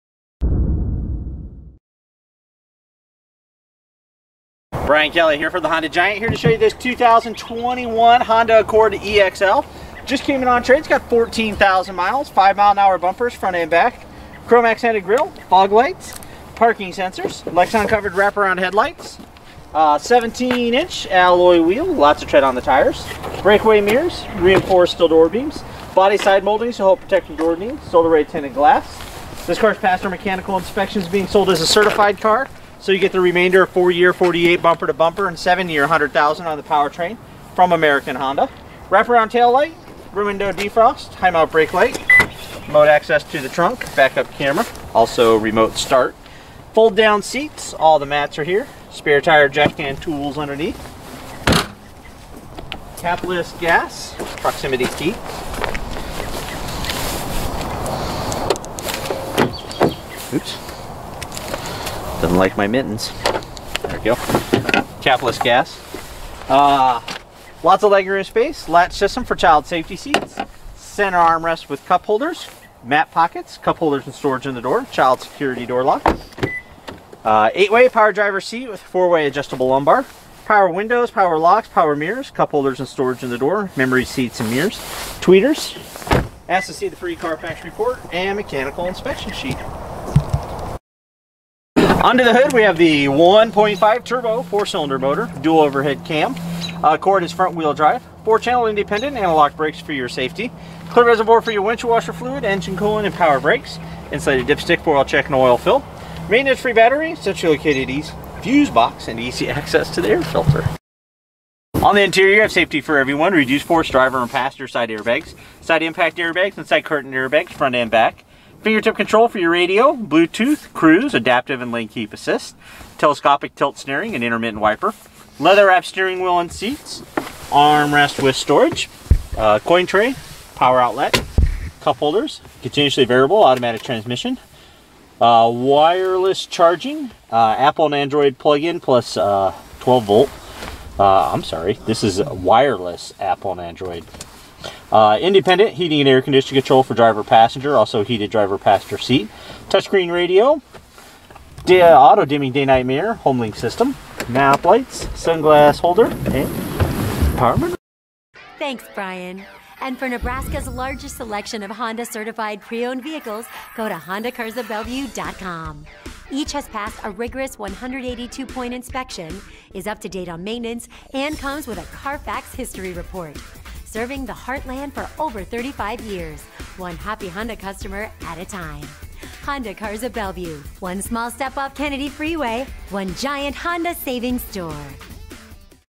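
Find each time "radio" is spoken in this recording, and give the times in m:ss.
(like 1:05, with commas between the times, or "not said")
1:59, 2:30.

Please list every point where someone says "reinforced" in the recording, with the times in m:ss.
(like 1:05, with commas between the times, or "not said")
0:24.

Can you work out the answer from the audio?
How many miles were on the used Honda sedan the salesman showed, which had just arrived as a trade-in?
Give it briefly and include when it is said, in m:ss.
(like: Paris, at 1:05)
14,000, at 0:11.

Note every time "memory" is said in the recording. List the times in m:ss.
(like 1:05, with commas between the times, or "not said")
1:23.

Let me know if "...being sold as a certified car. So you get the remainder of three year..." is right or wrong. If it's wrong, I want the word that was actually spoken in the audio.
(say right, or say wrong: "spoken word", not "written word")
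wrong: "four", not "three".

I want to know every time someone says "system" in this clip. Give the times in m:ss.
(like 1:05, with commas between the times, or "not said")
1:08, 2:33.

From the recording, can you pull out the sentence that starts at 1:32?
Under the hood, we have the 1.5 turbo four-cylinder motor, dual overhead cam.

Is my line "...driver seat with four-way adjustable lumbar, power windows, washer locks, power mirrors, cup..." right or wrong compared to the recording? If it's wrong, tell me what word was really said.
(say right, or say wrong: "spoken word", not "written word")
wrong: "power", not "washer".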